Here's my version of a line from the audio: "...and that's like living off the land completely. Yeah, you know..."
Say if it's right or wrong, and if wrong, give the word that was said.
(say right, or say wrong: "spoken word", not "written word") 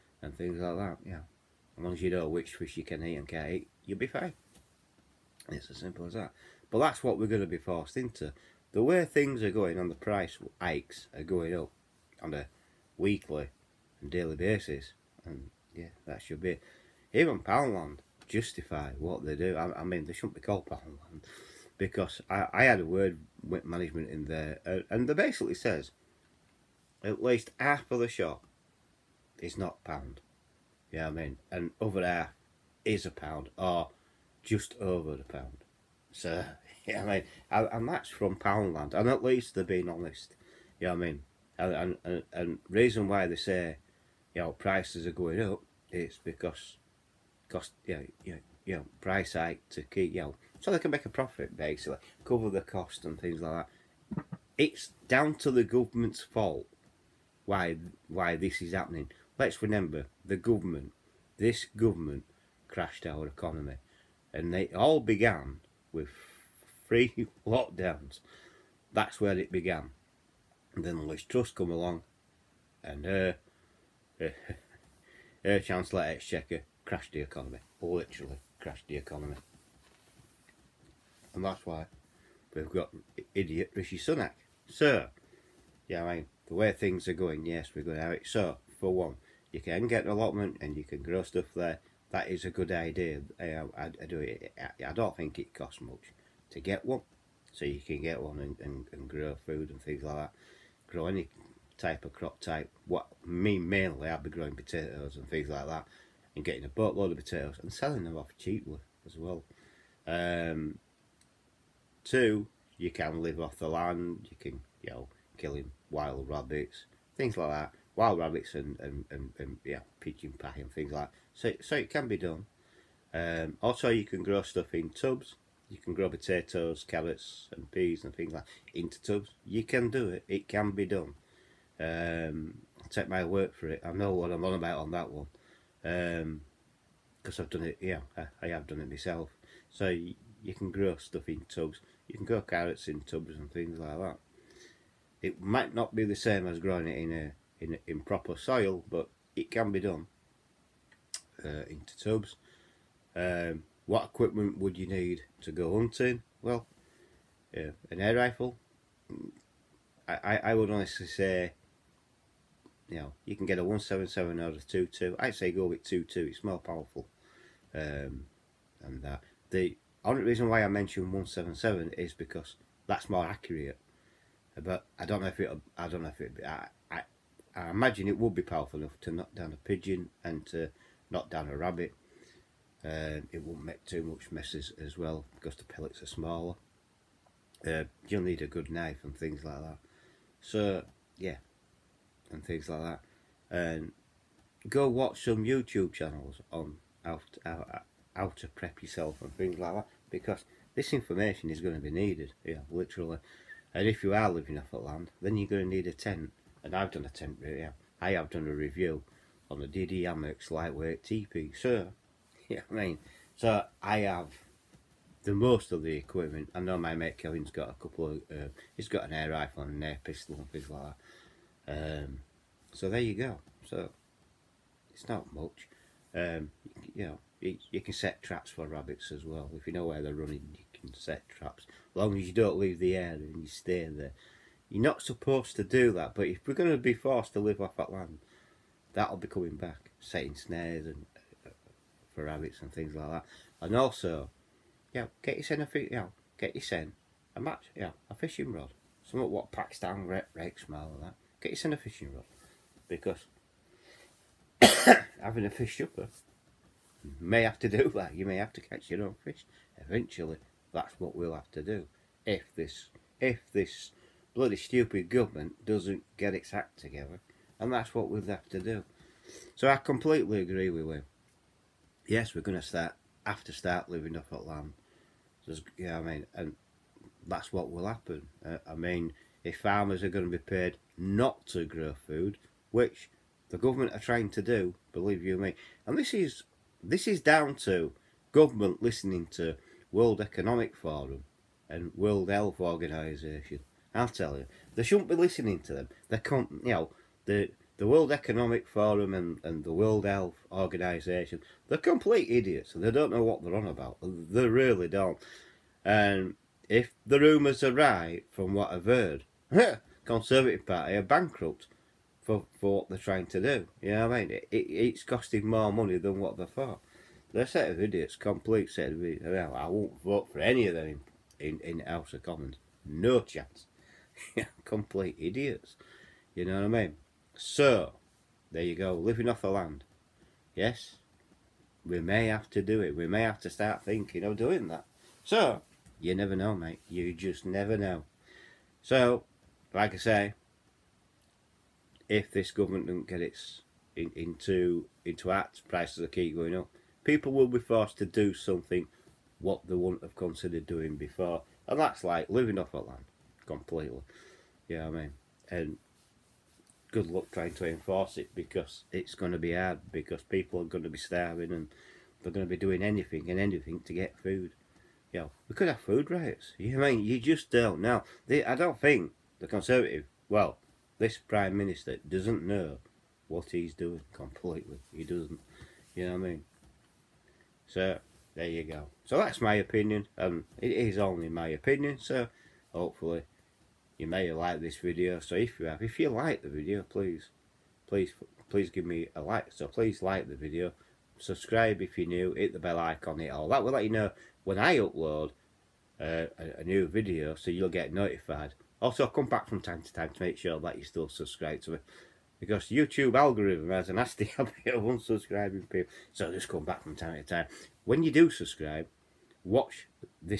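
right.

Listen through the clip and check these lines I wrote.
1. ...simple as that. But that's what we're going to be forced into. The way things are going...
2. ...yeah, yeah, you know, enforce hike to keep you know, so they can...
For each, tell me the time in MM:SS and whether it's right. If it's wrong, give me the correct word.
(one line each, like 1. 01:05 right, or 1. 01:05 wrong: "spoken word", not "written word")
1. 00:05 right
2. 00:47 wrong: "price", not "enforce".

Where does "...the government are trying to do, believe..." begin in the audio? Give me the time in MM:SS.
04:43.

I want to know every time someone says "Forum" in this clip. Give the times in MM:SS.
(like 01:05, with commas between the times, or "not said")
04:50, 04:58.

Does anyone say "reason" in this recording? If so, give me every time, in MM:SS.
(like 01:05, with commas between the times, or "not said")
00:42, 02:50.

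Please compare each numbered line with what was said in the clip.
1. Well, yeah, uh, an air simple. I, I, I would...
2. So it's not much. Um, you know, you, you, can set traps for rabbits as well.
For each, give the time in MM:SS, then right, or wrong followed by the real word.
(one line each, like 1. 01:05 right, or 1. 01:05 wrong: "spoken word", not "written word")
1. 02:36 wrong: "rifle", not "simple"
2. 03:43 right.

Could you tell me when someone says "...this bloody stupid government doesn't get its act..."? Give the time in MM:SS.
04:23.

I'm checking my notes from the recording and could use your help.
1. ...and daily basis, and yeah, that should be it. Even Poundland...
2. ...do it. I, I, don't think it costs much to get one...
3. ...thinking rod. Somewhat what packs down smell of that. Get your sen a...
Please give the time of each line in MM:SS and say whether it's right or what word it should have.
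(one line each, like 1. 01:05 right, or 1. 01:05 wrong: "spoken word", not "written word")
1. 00:13 right
2. 01:34 right
3. 04:08 wrong: "fishing", not "thinking".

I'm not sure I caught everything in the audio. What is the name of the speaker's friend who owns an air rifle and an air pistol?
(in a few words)
Kevin.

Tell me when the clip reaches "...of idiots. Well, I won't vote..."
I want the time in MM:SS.
05:18.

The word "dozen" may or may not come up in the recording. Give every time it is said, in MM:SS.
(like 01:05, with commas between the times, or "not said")
not said.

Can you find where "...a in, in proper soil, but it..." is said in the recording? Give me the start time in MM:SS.
02:27.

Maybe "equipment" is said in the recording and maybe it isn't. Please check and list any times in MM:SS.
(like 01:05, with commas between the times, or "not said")
02:34, 03:35.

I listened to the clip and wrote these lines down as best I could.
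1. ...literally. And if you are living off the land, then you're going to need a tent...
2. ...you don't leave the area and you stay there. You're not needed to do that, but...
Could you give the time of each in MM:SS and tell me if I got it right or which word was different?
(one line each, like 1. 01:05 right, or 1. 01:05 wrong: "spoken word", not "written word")
1. 03:22 right
2. 03:52 wrong: "supposed", not "needed".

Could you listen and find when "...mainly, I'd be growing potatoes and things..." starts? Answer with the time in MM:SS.
01:43.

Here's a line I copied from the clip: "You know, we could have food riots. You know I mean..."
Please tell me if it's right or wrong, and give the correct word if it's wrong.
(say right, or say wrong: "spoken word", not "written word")
right.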